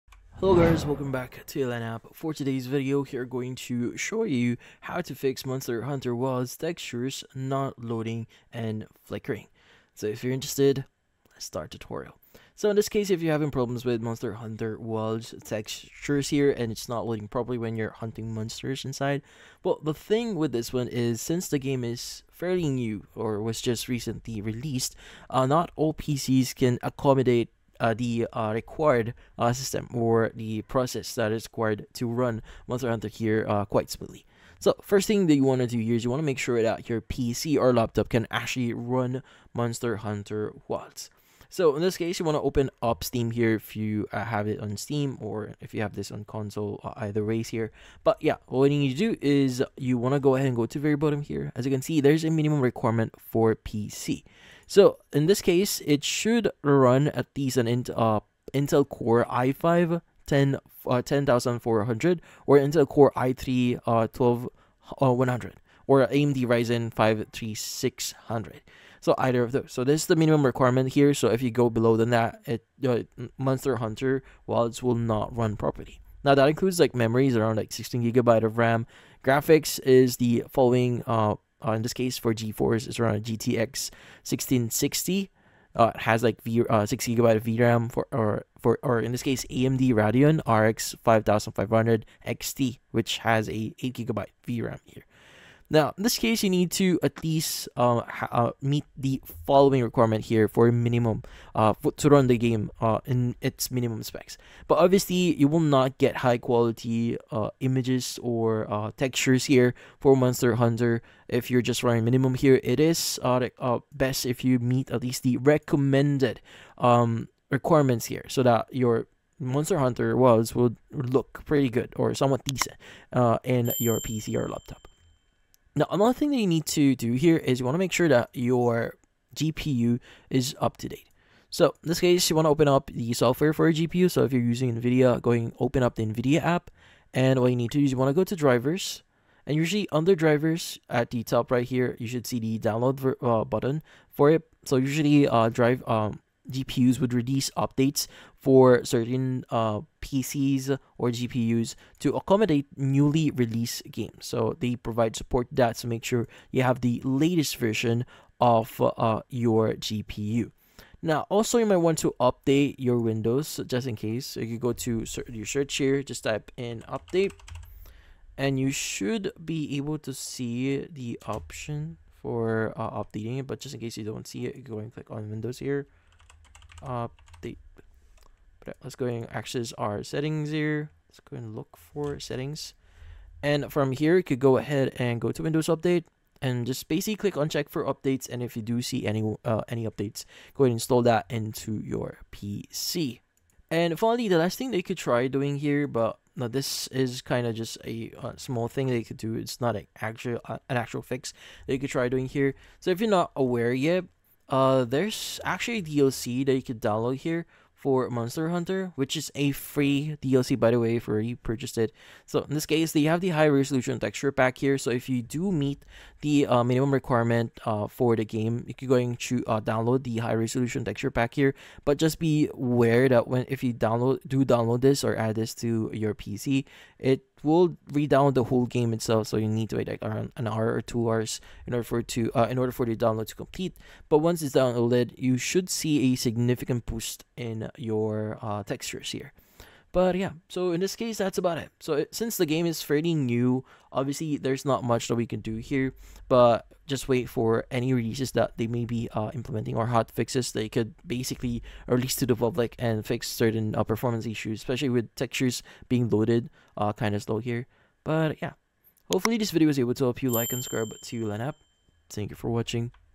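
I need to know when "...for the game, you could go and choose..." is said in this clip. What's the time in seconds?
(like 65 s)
217 s.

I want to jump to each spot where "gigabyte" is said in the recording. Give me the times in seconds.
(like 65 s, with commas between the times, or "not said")
78 s, 87 s, 93 s.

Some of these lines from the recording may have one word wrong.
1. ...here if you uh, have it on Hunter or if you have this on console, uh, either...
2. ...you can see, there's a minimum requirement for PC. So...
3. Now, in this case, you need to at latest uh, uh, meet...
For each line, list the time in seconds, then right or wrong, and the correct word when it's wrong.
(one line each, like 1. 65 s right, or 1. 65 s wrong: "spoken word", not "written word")
1. 43 s wrong: "Steam", not "Hunter"
2. 51 s right
3. 95 s wrong: "least", not "latest".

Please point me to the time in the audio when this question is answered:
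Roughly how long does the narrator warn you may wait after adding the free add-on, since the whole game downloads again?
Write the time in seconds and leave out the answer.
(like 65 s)
230 s.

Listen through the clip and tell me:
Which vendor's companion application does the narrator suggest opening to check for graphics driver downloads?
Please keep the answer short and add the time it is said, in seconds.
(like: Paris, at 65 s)
NVIDIA app, at 136 s.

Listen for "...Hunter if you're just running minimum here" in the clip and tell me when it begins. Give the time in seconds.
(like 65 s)
110 s.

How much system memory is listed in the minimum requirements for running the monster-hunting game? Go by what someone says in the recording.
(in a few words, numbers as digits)
16 GB.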